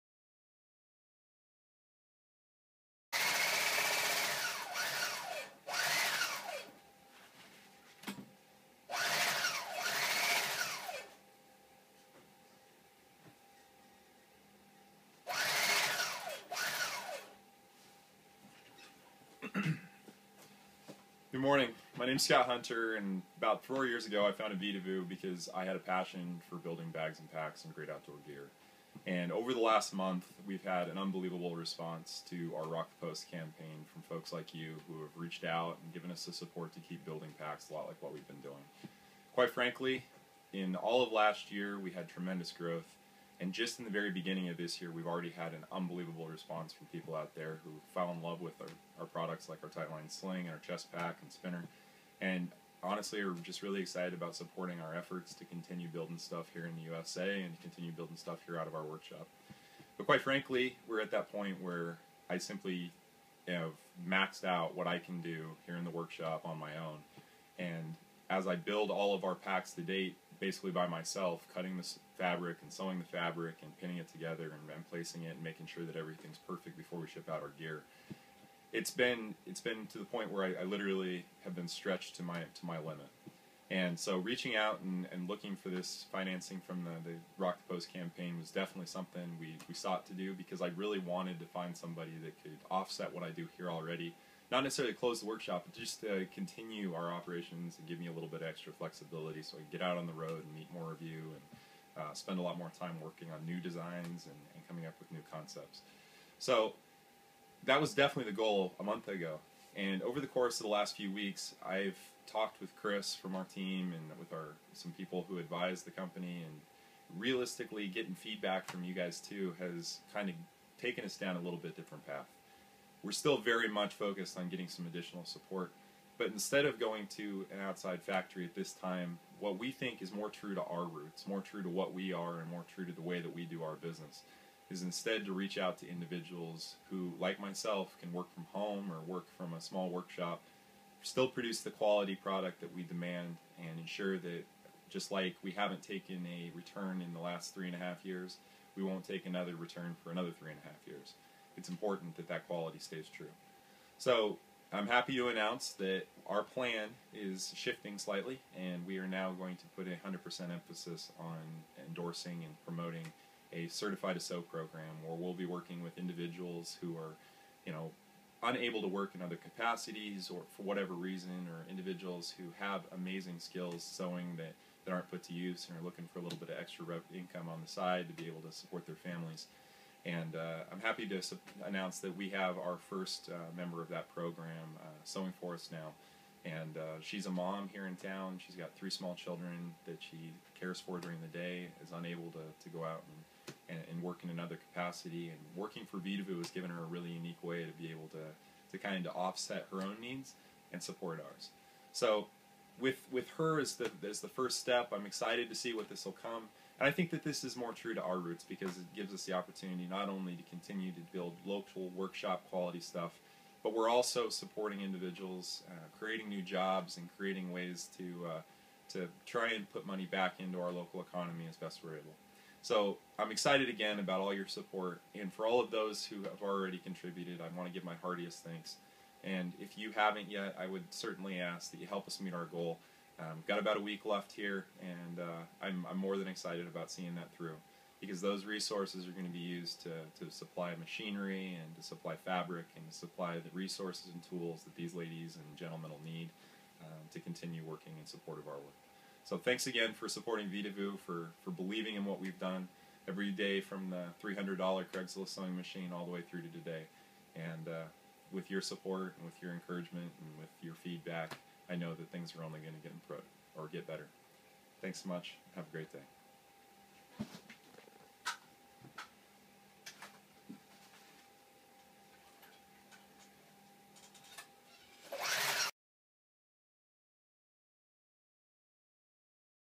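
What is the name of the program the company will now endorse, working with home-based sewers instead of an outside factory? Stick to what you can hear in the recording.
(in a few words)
Certify to Sew.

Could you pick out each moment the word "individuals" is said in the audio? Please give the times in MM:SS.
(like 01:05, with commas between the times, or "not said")
02:15, 02:45, 02:51, 03:34.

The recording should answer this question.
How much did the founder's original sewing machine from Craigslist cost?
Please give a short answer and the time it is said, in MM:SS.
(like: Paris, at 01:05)
$300, at 04:14.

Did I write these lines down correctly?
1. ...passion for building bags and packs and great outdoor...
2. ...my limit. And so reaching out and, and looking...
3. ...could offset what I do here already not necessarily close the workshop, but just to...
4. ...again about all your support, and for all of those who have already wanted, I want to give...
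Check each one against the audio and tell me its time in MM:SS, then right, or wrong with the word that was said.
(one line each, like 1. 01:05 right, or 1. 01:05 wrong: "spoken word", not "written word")
1. 00:25 right
2. 01:22 right
3. 01:32 right
4. 03:43 wrong: "contributed", not "wanted".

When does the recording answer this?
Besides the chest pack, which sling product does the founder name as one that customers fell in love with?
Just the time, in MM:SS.
00:49.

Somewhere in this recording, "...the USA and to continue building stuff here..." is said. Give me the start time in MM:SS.
00:56.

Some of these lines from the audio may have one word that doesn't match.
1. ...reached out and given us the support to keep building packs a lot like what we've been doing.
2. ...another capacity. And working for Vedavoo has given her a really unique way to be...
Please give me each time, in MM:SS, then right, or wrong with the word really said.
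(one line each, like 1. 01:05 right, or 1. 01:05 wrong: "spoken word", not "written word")
1. 00:35 right
2. 03:14 right.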